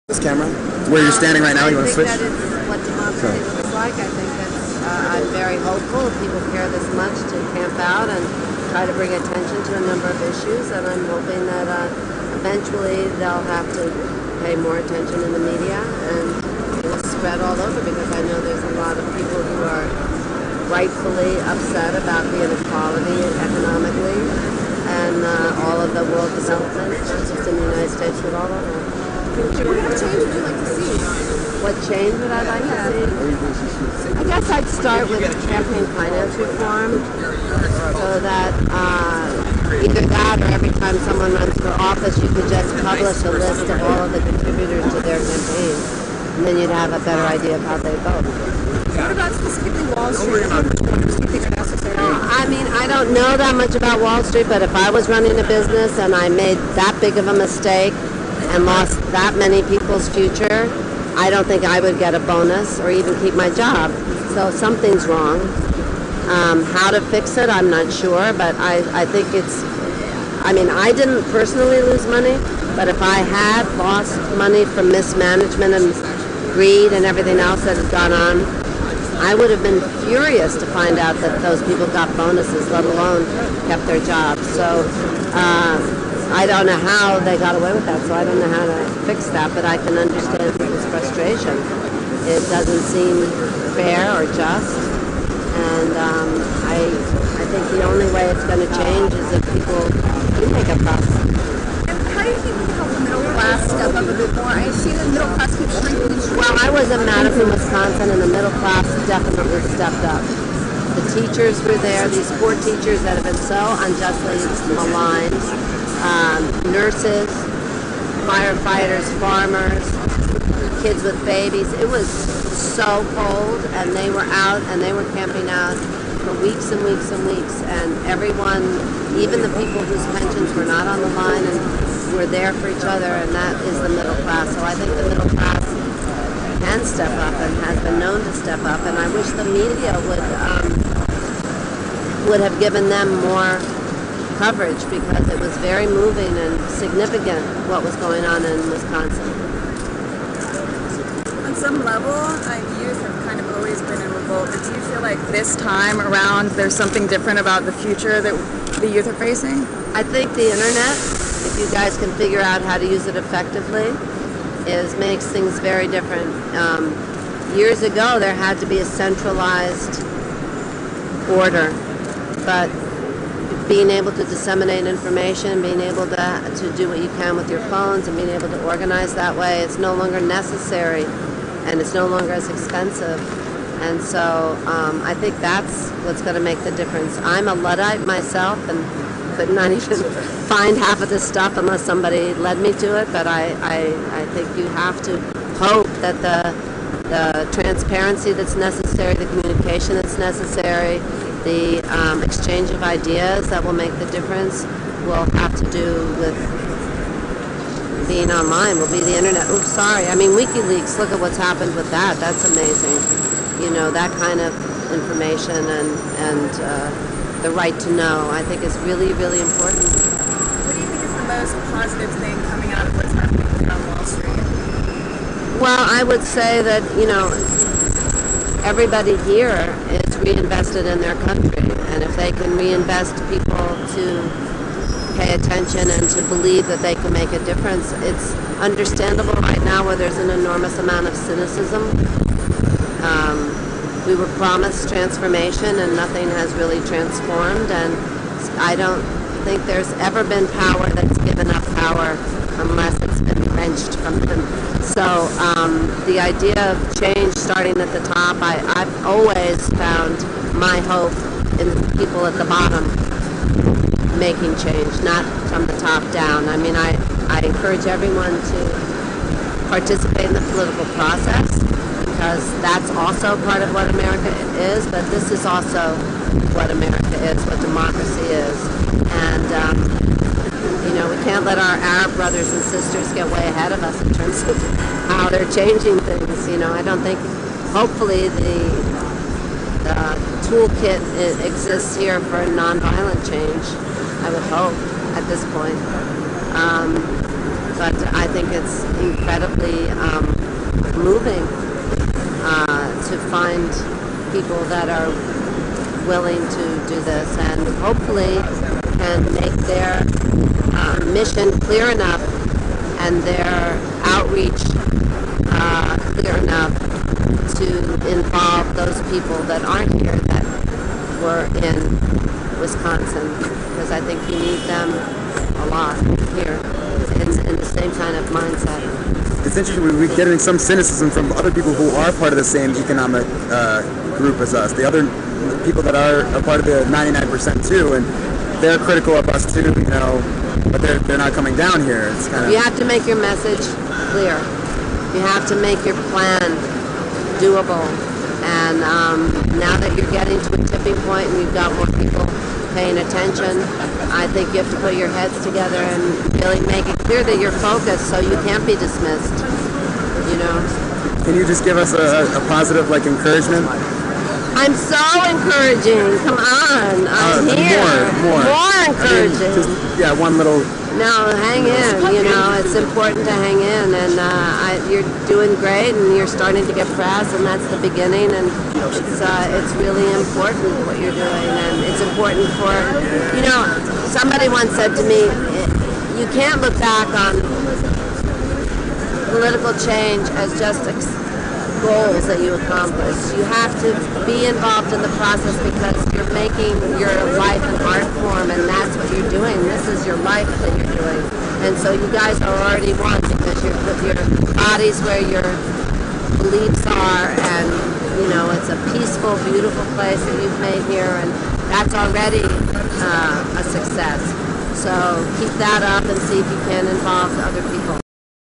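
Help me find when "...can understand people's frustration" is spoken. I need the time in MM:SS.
01:29.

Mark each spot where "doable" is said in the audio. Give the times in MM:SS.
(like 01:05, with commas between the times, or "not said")
05:47.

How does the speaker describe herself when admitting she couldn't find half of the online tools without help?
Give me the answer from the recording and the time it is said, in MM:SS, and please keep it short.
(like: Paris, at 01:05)
A Luddite, at 03:07.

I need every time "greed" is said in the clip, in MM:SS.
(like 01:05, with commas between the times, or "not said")
01:16.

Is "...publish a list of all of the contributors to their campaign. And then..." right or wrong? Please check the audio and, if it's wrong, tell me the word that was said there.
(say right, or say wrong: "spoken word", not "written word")
right.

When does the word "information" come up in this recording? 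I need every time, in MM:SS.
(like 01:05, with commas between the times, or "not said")
02:54, 03:34.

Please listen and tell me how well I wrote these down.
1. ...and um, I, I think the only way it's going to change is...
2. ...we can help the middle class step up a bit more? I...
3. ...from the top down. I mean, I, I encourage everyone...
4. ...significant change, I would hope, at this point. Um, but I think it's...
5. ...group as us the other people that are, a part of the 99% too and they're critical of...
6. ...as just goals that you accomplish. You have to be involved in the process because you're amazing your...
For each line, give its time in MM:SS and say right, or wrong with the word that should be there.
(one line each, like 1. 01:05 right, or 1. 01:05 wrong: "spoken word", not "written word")
1. 01:35 right
2. 01:42 right
3. 04:25 right
4. 04:52 wrong: "nonviolent", not "significant"
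5. 05:34 right
6. 06:30 wrong: "making", not "amazing".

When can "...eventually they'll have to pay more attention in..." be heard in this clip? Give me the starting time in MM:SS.
00:12.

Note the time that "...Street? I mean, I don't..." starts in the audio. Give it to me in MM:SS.
00:50.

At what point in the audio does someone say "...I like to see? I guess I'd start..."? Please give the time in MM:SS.
00:32.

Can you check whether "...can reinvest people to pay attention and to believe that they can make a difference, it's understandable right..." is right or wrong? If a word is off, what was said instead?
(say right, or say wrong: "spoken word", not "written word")
right.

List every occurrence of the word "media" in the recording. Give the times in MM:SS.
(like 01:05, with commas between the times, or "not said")
00:15, 02:19.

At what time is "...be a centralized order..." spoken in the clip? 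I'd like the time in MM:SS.
02:48.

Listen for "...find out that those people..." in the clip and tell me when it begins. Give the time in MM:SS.
01:20.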